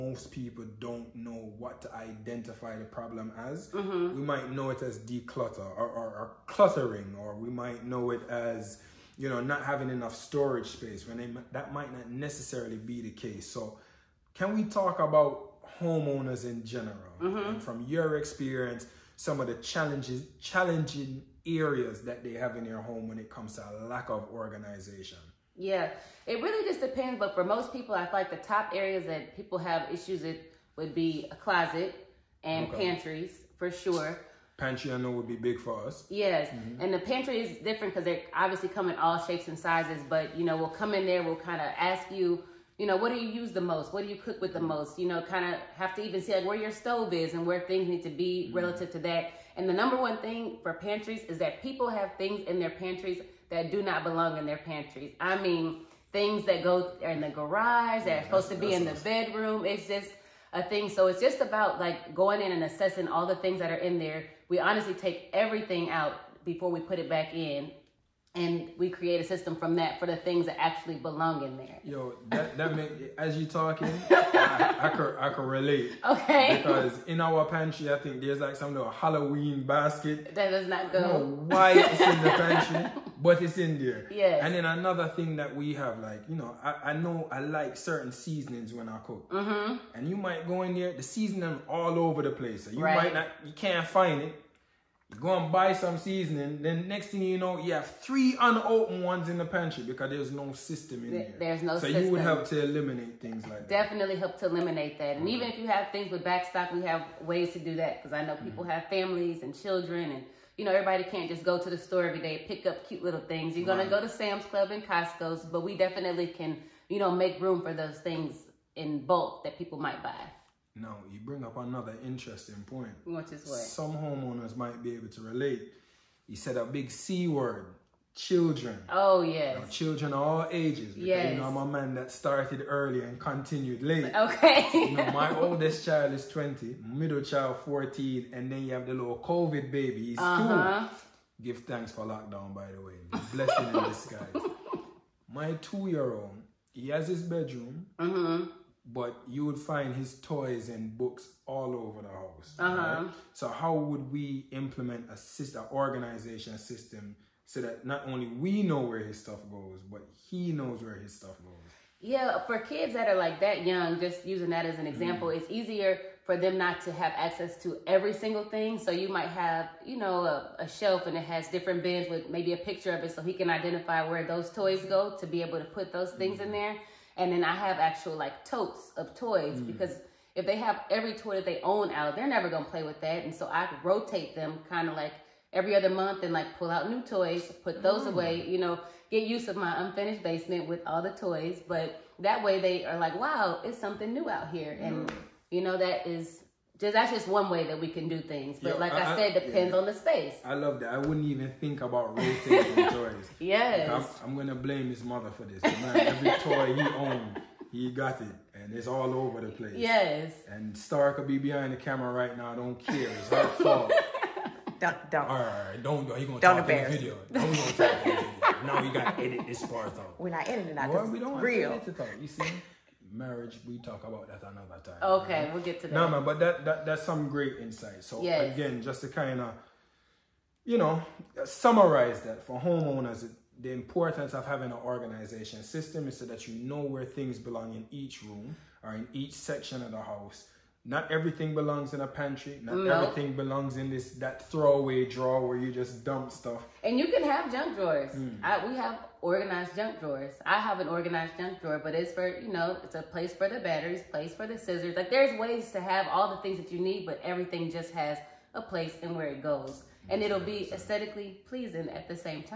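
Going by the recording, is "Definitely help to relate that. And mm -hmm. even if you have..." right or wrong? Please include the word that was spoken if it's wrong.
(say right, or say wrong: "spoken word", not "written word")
wrong: "eliminate", not "relate".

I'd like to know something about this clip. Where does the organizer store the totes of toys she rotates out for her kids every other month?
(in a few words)
Unfinished basement.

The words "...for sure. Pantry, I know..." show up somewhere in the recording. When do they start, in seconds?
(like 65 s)
33 s.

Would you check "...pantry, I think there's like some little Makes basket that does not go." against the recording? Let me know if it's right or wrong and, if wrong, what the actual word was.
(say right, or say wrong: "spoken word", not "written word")
wrong: "Halloween", not "Makes".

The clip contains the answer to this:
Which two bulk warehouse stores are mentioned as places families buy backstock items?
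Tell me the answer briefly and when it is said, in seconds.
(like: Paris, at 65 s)
Sam's Club and Costco, at 114 s.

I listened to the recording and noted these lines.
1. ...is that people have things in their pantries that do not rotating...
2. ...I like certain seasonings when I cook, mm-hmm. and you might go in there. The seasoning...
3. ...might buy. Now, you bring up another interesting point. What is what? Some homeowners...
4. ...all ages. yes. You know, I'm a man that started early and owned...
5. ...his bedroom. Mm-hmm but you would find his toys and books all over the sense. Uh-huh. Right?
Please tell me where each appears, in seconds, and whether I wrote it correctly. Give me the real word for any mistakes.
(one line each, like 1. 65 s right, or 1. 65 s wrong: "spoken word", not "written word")
1. 51 s wrong: "belong", not "rotating"
2. 87 s right
3. 119 s right
4. 130 s wrong: "continued", not "owned"
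5. 147 s wrong: "house", not "sense".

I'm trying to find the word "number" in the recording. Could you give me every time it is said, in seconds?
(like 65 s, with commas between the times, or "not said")
49 s.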